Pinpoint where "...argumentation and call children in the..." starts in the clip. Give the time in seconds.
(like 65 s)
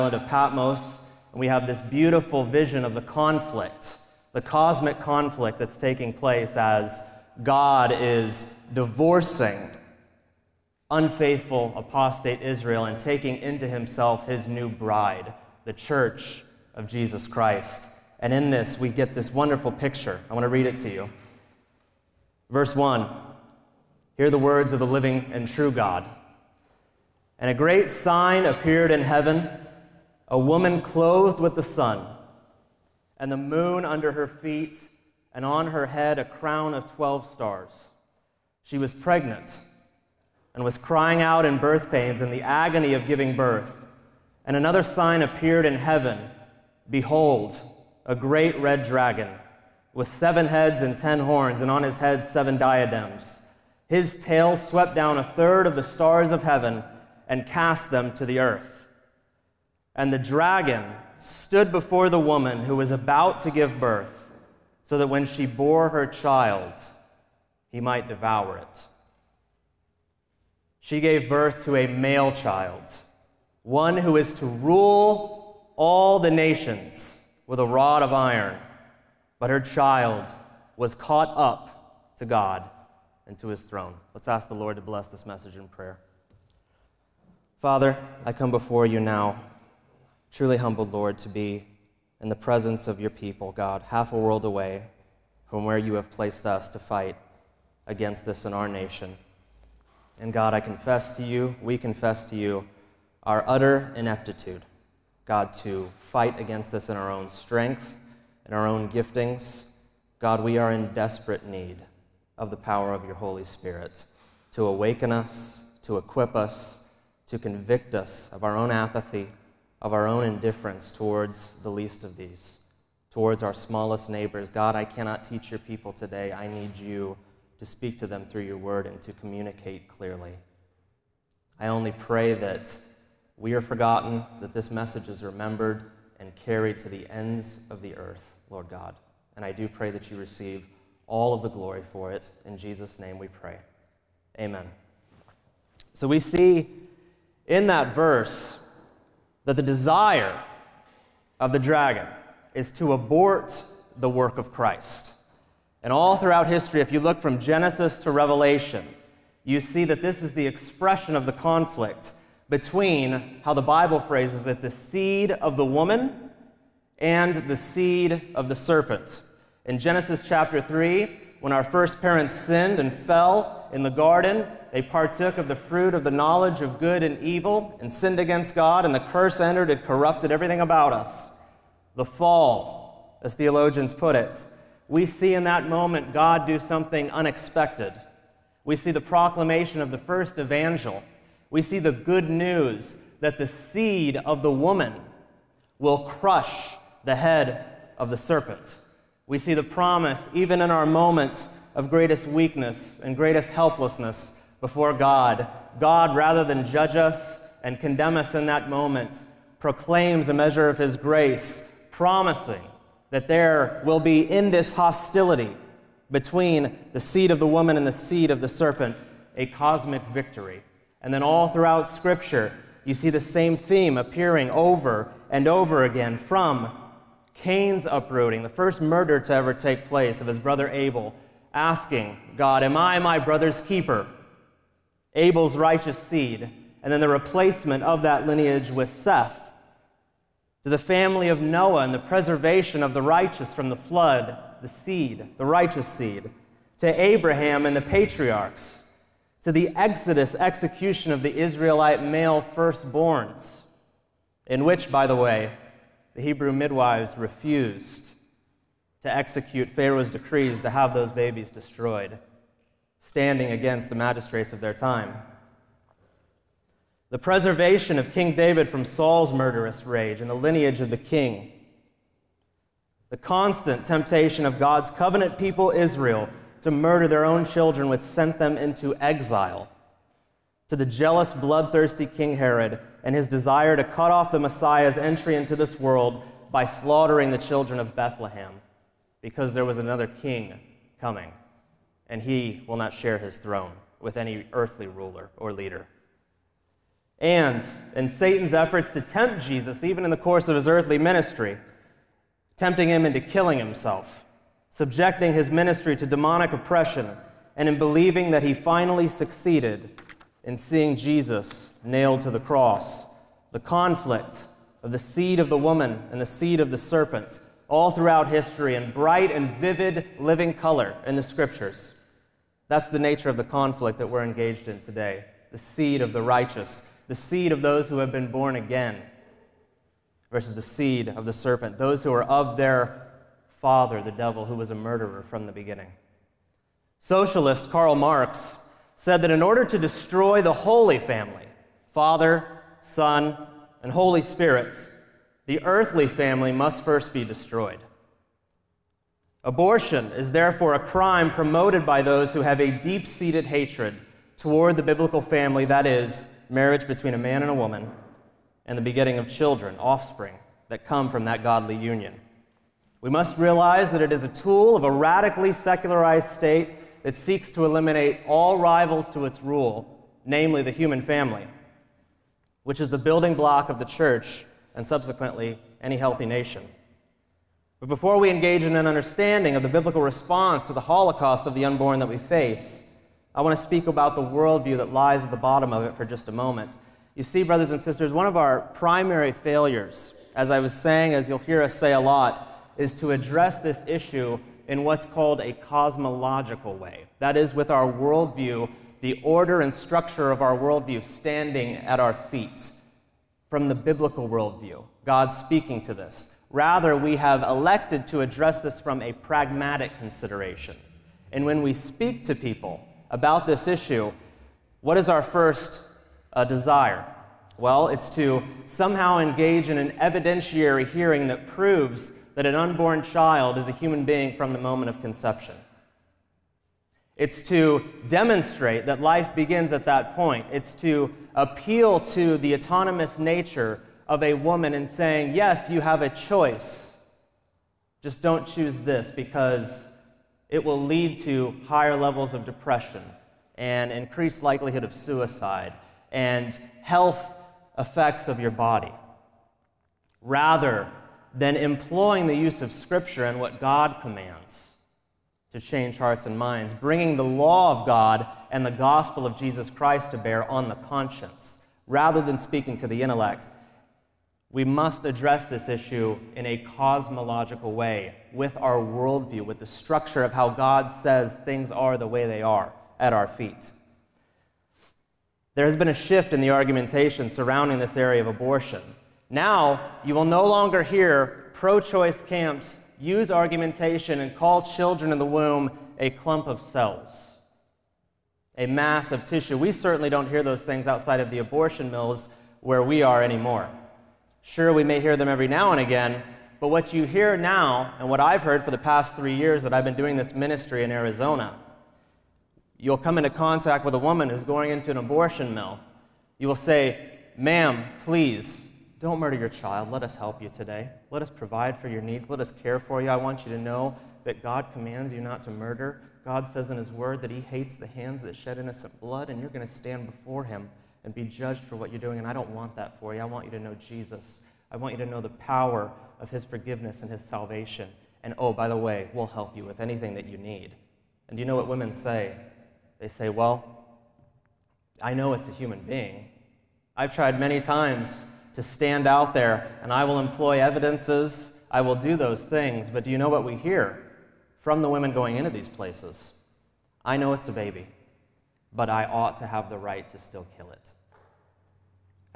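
483 s.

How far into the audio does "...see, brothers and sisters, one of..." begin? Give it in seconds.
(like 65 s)
387 s.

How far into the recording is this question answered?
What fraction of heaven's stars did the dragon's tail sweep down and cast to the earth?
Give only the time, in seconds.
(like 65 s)
55 s.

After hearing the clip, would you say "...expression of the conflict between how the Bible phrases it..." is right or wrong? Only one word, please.
right.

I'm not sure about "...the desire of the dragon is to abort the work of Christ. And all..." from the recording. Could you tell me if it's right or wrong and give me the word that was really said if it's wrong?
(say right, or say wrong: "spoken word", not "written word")
right.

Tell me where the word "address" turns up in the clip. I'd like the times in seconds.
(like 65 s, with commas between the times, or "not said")
393 s, 408 s, 465 s.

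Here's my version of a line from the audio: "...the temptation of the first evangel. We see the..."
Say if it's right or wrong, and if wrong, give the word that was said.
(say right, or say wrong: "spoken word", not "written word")
wrong: "proclamation", not "temptation".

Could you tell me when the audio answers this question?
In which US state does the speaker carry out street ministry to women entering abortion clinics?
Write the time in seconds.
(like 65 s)
500 s.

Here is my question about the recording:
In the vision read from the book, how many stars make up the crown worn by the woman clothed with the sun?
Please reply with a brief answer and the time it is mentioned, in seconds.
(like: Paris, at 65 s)
12, at 36 s.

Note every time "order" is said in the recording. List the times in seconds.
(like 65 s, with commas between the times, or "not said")
339 s, 399 s.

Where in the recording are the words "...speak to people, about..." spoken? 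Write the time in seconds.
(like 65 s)
411 s.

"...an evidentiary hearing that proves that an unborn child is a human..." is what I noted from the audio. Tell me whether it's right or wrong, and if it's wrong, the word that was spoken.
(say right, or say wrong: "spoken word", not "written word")
right.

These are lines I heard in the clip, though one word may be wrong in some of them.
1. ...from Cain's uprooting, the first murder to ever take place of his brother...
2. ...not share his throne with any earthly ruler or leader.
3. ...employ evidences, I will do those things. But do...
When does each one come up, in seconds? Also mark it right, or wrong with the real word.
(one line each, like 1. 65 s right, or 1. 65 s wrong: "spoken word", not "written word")
1. 226 s right
2. 292 s right
3. 540 s right.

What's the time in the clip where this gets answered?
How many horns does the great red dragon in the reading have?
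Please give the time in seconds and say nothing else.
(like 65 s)
50 s.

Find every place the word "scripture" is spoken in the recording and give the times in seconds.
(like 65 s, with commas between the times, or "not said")
221 s, 321 s, 452 s.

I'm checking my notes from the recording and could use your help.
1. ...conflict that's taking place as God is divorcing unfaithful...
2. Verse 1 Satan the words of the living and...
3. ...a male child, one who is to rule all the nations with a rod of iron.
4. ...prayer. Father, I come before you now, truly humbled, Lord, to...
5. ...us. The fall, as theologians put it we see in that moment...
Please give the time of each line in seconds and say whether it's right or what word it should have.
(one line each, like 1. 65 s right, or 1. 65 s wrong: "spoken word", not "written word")
1. 5 s right
2. 22 s wrong: "Hear", not "Satan"
3. 71 s right
4. 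85 s right
5. 180 s right.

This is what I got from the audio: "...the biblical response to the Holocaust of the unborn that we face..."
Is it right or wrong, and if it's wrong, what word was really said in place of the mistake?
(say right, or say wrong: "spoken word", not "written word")
right.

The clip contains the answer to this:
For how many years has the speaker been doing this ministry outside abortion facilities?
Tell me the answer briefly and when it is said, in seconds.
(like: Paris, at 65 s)
3, at 499 s.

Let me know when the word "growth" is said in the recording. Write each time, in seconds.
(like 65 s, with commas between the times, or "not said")
not said.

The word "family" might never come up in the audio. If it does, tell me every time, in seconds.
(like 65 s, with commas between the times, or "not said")
240 s, 340 s, 346 s, 355 s, 371 s.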